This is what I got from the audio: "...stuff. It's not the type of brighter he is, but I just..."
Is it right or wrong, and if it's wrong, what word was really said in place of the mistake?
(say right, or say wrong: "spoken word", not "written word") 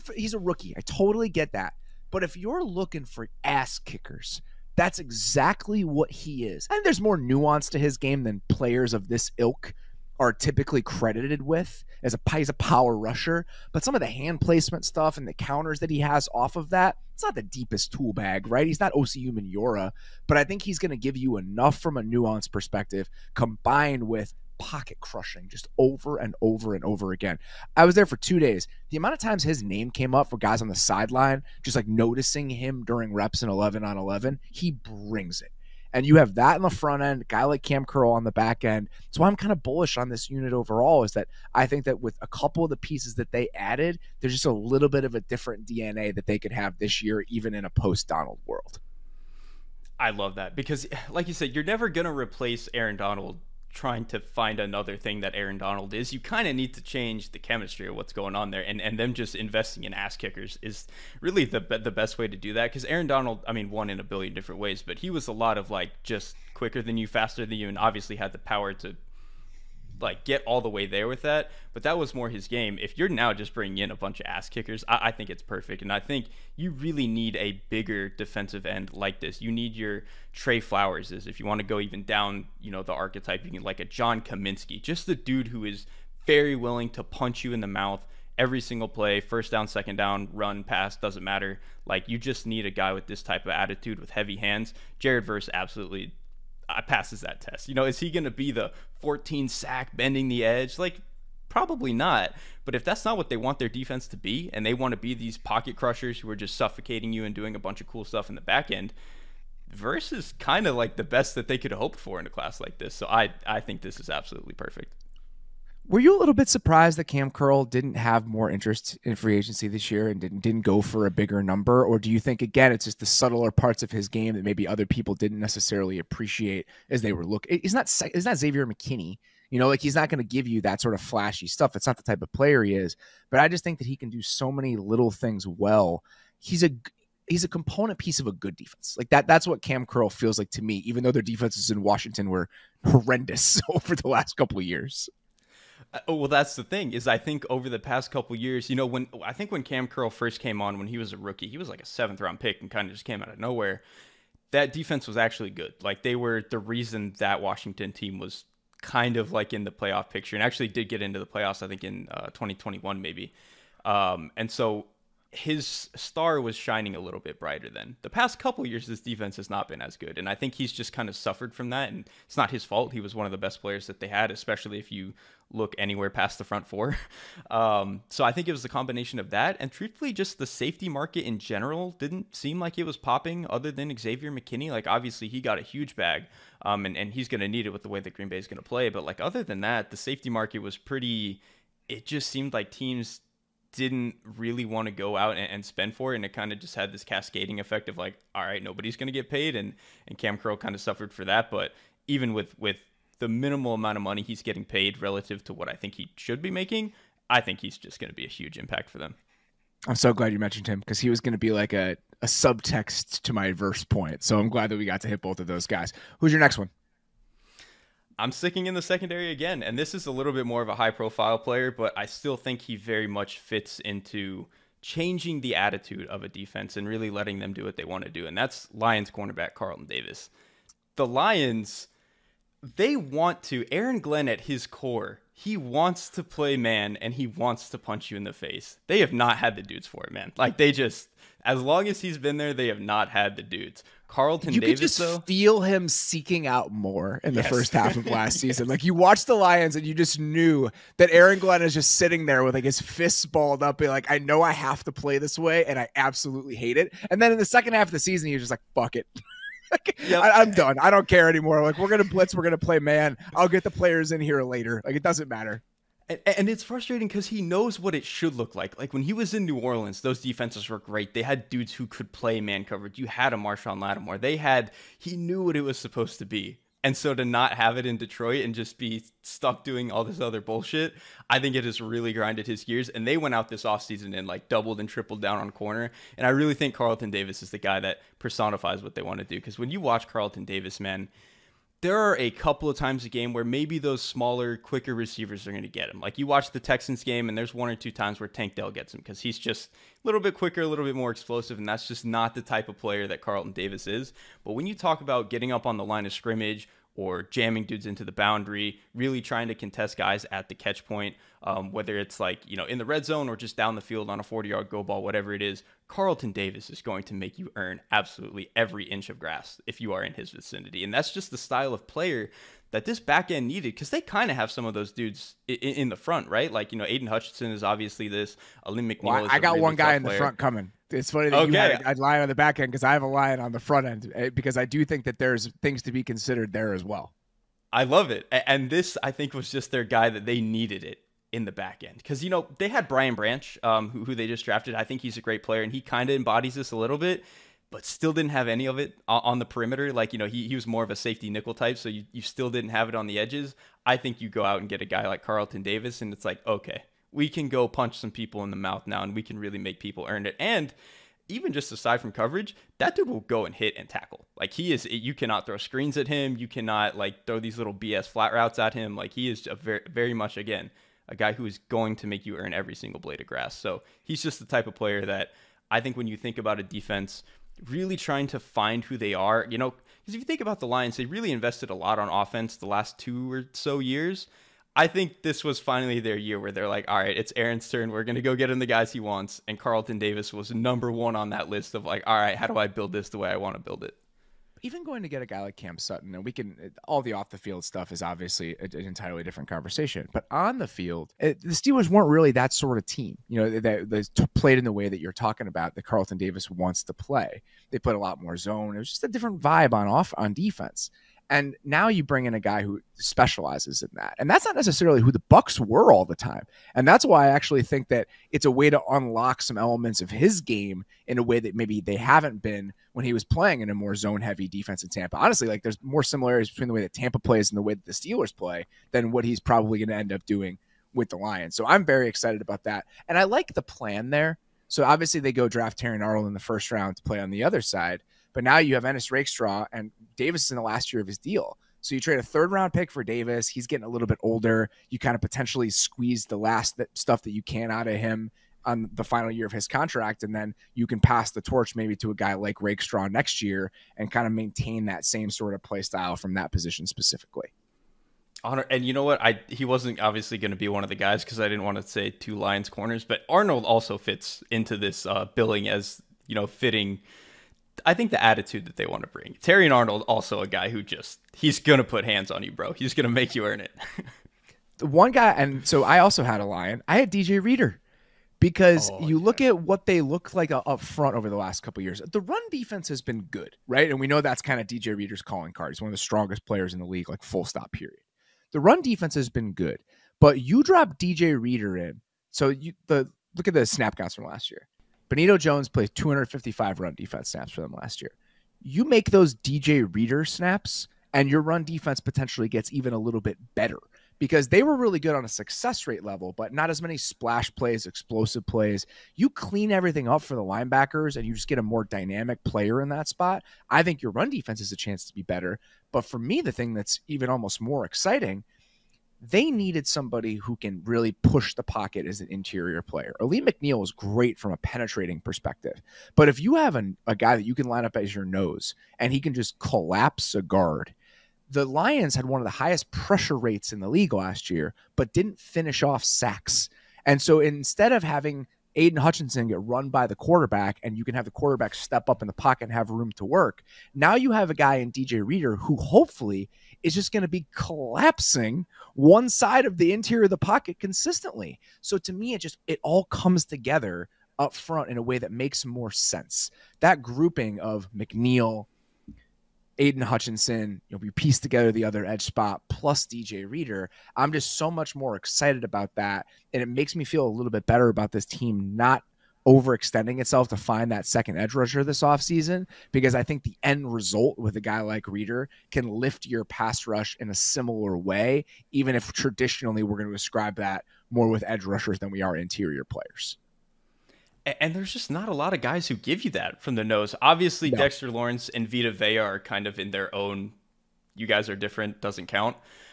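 wrong: "player", not "brighter".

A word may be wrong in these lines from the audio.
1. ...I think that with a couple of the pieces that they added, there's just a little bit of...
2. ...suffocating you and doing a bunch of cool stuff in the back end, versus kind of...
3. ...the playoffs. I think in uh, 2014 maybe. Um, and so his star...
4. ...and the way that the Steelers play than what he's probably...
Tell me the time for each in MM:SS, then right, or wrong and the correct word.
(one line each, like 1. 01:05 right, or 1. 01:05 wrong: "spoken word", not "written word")
1. 00:41 right
2. 01:46 right
3. 02:41 wrong: "2021", not "2014"
4. 07:07 right.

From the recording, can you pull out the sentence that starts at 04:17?
And then in the second half of the season, he was just like, fuck it.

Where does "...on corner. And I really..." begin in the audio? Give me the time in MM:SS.
04:45.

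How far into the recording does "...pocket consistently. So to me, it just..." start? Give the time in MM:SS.
09:10.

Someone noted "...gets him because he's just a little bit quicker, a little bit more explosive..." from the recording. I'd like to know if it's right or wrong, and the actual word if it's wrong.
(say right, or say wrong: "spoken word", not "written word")
right.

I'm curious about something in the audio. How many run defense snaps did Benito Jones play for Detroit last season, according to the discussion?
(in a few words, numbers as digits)
255.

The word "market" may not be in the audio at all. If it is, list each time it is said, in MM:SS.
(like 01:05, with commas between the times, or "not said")
03:00, 03:10.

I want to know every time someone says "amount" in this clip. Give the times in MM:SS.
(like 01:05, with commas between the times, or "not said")
00:28, 03:23.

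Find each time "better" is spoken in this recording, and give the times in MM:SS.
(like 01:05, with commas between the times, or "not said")
08:23, 08:35, 09:27.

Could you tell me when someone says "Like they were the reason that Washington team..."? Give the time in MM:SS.
02:35.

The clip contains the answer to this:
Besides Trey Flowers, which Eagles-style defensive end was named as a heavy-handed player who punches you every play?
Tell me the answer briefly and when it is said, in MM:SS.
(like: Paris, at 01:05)
John Cominsky, at 01:23.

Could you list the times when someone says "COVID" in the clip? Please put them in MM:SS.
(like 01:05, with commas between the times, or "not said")
not said.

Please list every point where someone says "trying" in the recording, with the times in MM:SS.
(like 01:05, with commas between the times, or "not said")
00:53, 05:09, 06:17.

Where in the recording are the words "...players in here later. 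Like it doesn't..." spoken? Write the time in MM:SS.
04:23.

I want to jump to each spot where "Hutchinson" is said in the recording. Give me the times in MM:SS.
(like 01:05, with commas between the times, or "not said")
05:27, 08:59, 09:20.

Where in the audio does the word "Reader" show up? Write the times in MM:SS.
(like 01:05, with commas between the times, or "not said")
07:57, 08:04, 08:11, 08:19, 09:05, 09:23, 09:35.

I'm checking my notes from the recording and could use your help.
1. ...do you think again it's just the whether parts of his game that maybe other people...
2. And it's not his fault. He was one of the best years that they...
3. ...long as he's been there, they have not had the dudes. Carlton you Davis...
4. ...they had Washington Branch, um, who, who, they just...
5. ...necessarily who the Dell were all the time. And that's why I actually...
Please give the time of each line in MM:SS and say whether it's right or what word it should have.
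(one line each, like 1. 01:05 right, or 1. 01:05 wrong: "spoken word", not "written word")
1. 02:01 wrong: "subtler", not "whether"
2. 02:51 wrong: "players", not "years"
3. 04:01 right
4. 05:42 wrong: "Brian", not "Washington"
5. 06:54 wrong: "Bucs", not "Dell".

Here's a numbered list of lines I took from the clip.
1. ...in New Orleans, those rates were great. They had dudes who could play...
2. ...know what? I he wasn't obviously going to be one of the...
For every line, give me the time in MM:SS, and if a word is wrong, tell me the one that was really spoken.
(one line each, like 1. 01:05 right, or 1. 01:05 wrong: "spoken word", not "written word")
1. 04:29 wrong: "defenses", not "rates"
2. 07:38 right.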